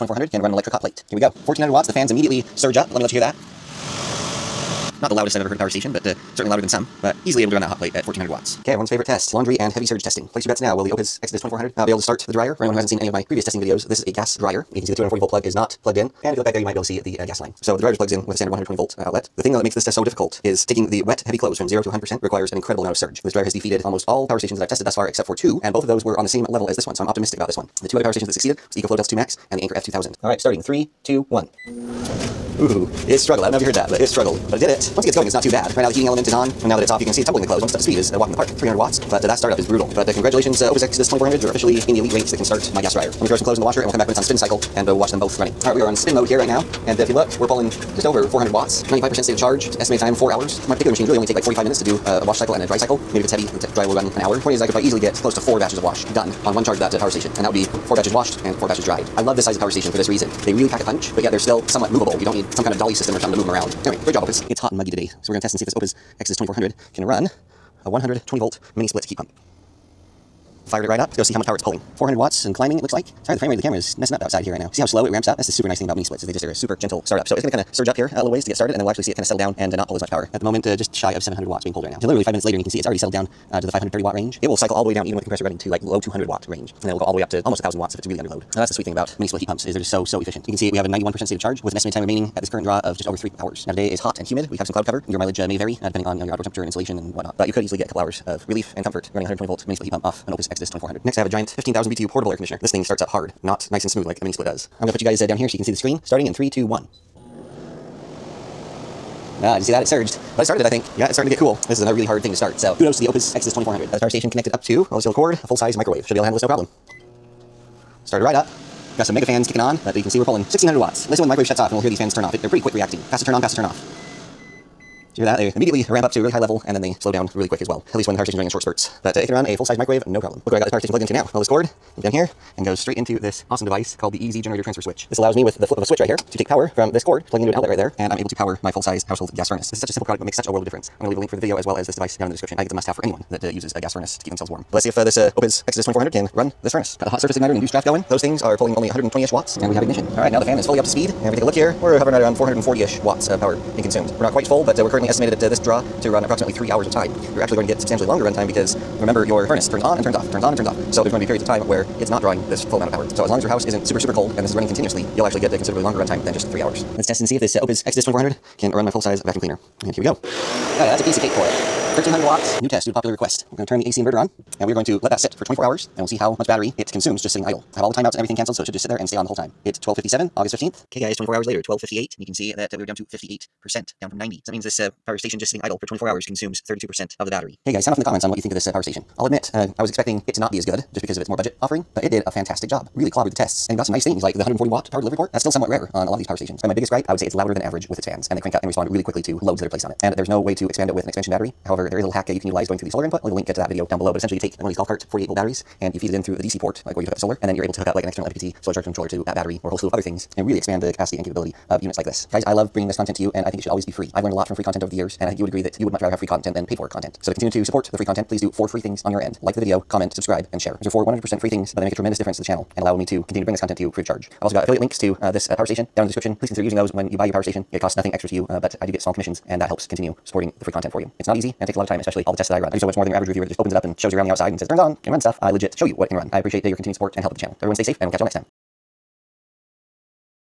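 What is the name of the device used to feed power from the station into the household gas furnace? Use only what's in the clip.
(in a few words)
EZ generator transfer switch.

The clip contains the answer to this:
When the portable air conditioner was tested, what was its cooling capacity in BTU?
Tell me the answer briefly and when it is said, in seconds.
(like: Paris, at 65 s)
15,000, at 101 s.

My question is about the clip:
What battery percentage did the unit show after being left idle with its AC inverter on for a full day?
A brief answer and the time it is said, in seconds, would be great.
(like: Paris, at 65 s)
58%, at 183 s.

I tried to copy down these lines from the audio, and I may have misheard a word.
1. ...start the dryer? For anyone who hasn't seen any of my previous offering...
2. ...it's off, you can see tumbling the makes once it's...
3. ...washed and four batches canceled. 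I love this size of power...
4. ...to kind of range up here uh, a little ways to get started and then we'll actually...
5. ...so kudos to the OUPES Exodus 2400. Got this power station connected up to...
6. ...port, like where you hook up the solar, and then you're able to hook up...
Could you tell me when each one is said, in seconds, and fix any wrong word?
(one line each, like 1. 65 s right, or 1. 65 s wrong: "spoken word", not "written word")
1. 12 s wrong: "testing", not "offering"
2. 36 s wrong: "clothes", not "makes"
3. 58 s wrong: "dried", not "canceled"
4. 77 s wrong: "surge", not "range"
5. 112 s right
6. 206 s right.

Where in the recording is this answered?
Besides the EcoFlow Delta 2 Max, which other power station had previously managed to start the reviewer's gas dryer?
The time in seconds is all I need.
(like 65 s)
29 s.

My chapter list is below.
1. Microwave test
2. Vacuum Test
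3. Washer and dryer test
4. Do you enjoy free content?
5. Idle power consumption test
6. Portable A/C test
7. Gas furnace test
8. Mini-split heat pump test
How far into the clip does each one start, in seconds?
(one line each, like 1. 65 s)
1. 113 s
2. 166 s
3. 8 s
4. 187 s
5. 172 s
6. 100 s
7. 130 s
8. 64 s.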